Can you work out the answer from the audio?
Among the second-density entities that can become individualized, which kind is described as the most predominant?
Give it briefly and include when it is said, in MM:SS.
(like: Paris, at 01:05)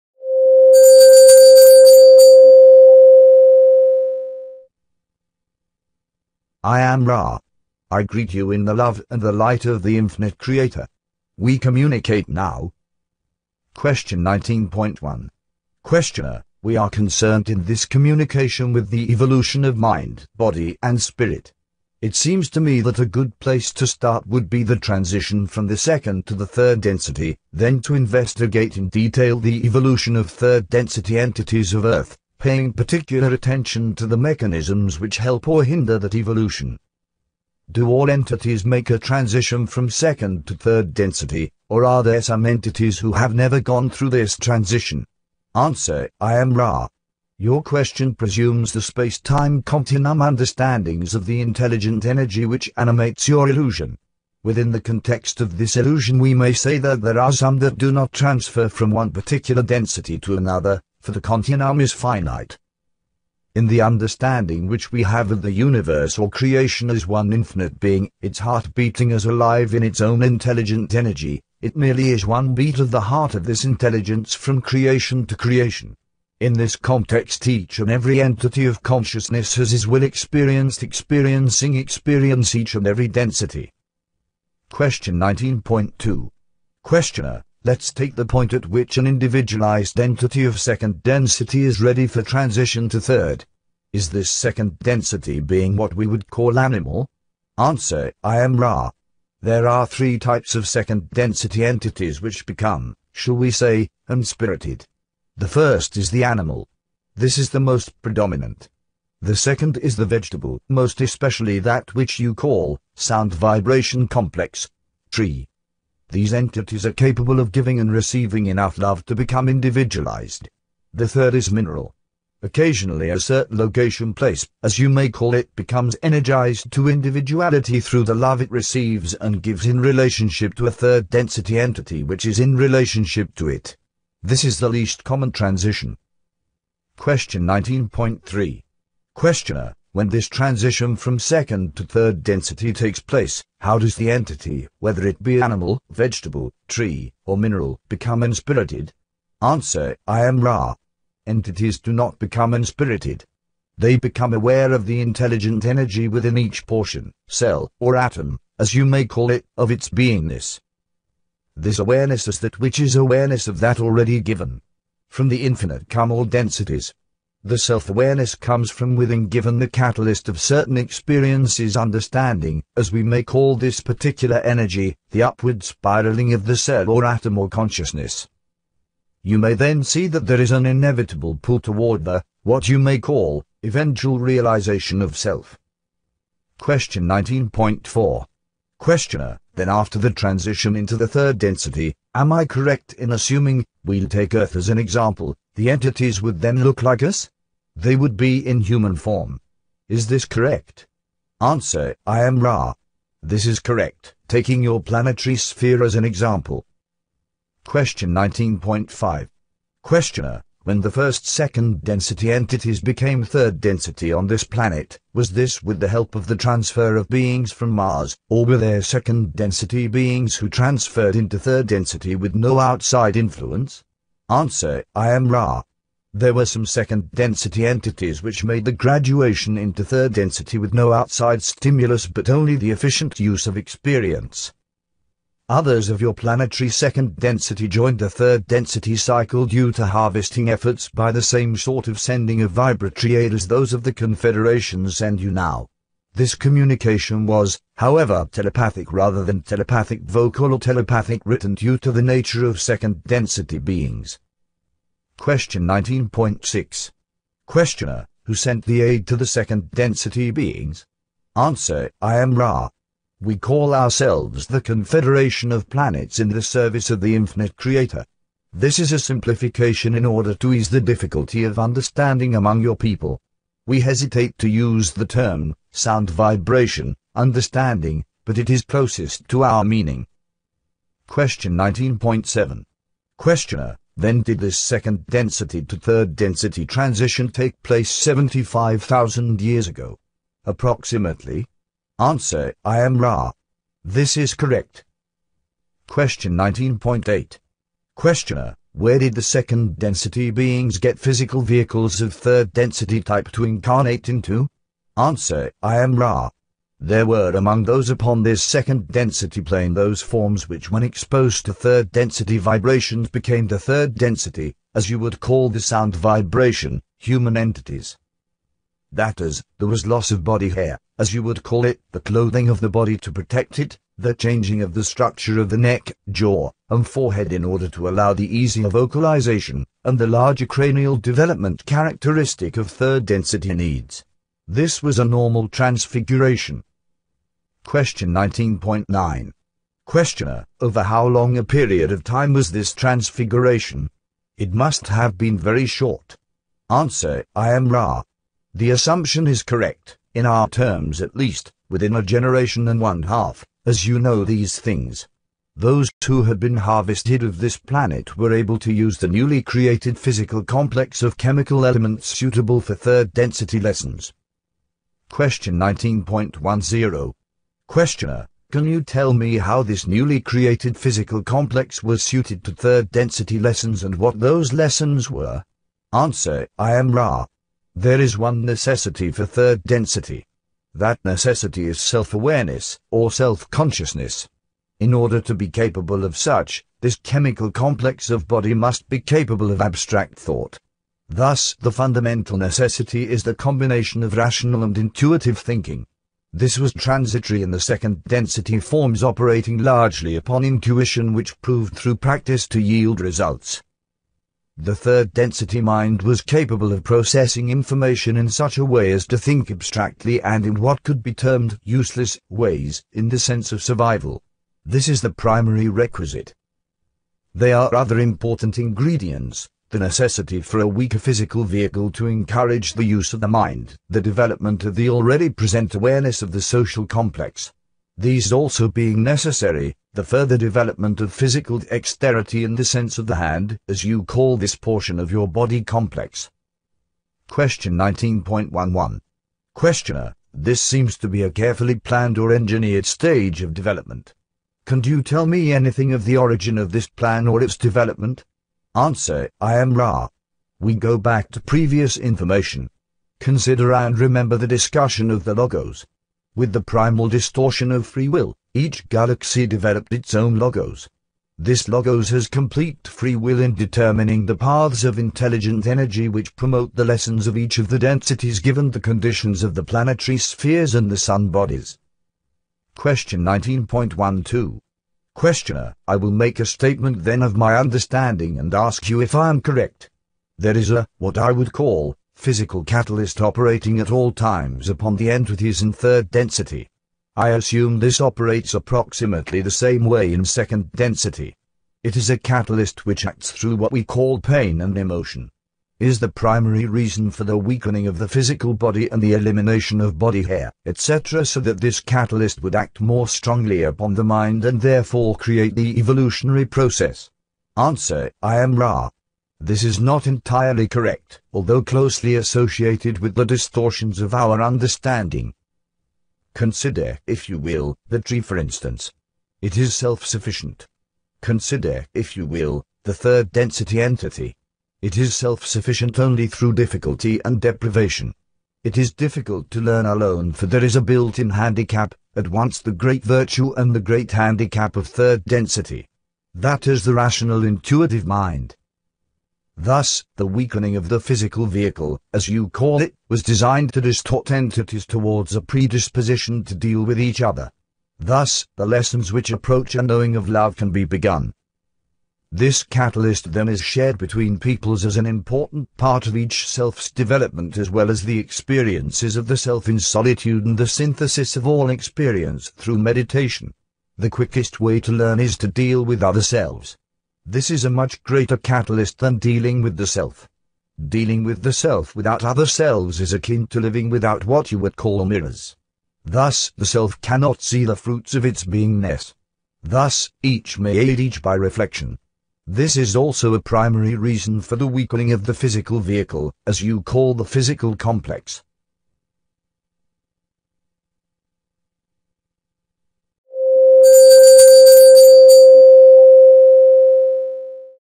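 The animal, at 01:45.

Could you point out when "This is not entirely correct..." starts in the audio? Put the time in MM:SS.
08:29.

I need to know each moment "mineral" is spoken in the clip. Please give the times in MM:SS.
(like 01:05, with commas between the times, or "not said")
02:01, 02:27.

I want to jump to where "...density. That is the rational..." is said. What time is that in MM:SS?
08:55.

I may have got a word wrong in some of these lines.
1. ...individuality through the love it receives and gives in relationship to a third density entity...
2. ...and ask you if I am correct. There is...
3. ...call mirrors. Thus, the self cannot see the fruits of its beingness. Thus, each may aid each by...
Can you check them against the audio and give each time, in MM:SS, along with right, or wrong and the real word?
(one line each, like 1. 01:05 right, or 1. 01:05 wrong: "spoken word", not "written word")
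1. 02:06 right
2. 07:58 right
3. 09:34 right.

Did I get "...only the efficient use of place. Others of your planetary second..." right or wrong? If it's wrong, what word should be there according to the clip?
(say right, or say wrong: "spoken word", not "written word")
wrong: "experience", not "place".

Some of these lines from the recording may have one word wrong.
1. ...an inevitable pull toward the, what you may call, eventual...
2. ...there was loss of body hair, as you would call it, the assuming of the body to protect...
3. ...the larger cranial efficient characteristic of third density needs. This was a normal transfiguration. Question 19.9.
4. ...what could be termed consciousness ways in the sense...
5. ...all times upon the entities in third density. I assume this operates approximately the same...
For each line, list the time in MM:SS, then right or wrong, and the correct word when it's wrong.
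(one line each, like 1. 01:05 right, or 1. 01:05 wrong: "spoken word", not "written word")
1. 03:00 right
2. 05:19 wrong: "clothing", not "assuming"
3. 05:29 wrong: "development", not "efficient"
4. 06:50 wrong: "useless", not "consciousness"
5. 08:03 right.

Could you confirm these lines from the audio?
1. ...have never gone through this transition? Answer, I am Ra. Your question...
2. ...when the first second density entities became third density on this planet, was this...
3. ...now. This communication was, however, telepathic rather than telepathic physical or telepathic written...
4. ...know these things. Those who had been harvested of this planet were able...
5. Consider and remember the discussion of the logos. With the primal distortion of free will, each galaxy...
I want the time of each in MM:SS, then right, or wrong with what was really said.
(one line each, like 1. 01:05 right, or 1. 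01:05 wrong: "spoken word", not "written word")
1. 00:43 right
2. 03:30 right
3. 04:05 wrong: "vocal", not "physical"
4. 05:53 right
5. 07:33 right.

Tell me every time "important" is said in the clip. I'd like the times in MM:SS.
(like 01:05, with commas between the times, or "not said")
06:57, 09:15.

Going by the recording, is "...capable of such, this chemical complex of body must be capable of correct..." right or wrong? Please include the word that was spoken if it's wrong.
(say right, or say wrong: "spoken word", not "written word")
wrong: "abstract", not "correct".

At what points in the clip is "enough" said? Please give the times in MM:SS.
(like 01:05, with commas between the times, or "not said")
01:58.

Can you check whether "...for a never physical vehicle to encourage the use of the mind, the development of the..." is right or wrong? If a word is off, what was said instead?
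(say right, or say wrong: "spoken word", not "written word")
wrong: "weaker", not "never".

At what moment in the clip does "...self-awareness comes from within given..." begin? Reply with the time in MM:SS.
02:47.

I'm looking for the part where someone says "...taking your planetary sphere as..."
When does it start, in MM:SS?
03:24.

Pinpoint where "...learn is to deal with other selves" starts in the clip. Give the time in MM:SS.
09:24.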